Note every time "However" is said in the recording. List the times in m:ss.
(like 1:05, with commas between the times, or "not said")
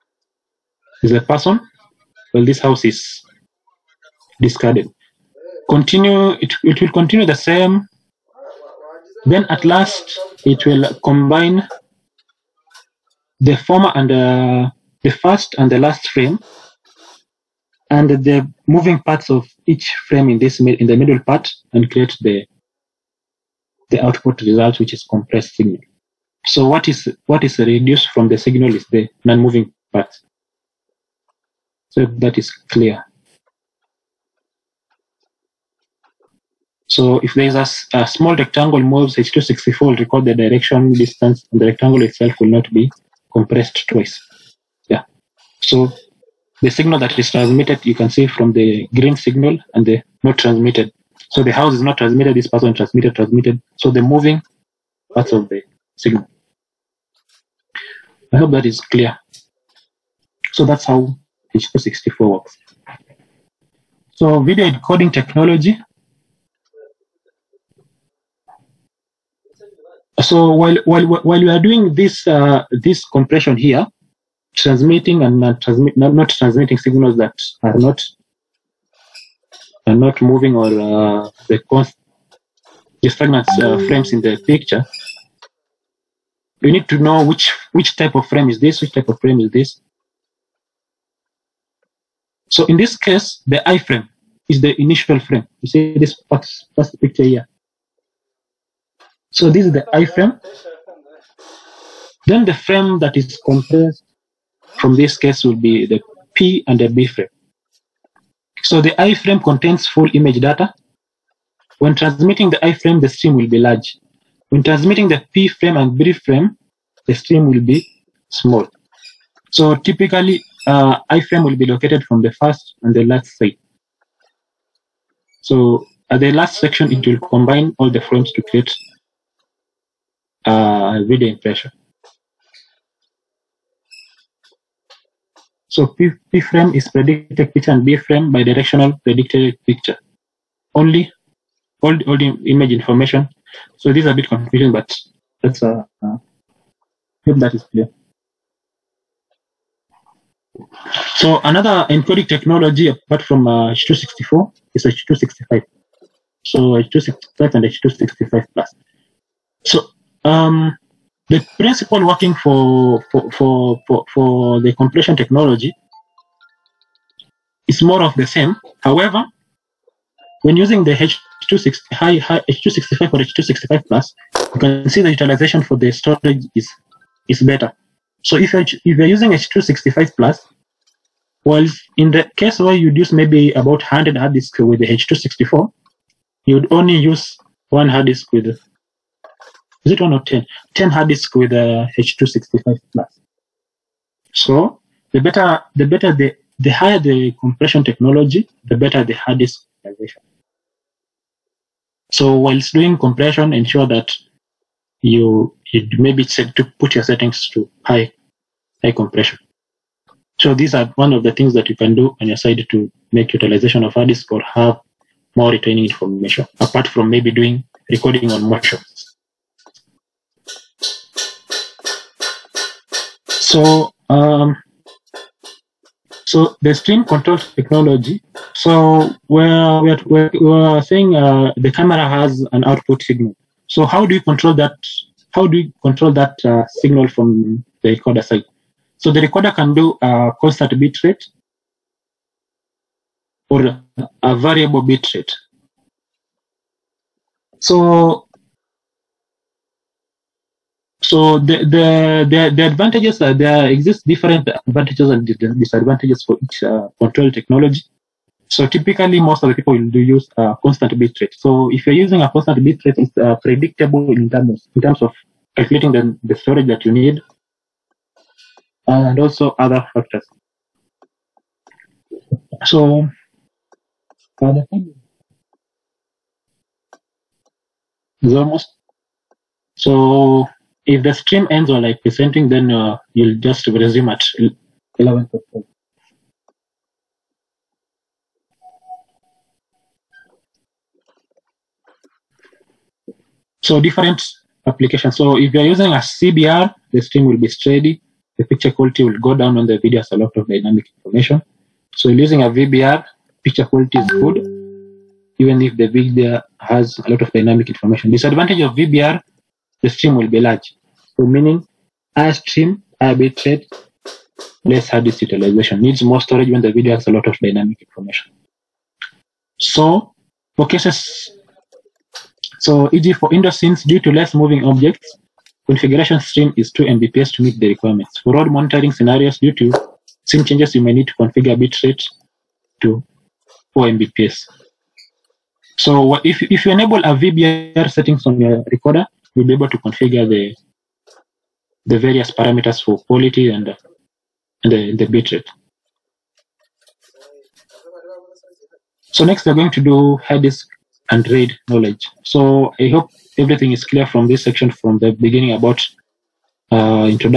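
2:48.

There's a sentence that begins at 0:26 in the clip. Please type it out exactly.
So what is what is reduced from the signal is the non-moving part.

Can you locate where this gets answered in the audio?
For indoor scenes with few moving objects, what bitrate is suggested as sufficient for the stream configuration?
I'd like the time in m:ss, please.
5:26.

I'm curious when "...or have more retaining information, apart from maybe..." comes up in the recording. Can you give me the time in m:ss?
3:34.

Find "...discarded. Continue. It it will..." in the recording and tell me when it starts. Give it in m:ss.
0:04.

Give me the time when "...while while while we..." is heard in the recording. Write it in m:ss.
1:10.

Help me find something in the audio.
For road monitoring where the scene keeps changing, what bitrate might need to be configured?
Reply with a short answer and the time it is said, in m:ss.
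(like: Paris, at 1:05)
4 Mbps, at 5:33.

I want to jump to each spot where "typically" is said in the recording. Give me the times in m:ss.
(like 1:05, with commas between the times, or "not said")
1:59, 4:18.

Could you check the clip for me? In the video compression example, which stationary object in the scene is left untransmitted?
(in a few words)
The house.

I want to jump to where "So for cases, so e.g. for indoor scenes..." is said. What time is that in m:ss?
5:19.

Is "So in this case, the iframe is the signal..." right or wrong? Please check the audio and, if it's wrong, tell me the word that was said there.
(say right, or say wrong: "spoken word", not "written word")
wrong: "initial", not "signal".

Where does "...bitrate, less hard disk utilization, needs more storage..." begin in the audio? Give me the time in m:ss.
5:13.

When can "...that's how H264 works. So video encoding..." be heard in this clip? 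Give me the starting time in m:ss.
1:00.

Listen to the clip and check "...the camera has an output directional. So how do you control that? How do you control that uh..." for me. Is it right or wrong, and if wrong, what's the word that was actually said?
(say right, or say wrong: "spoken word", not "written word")
wrong: "signal", not "directional".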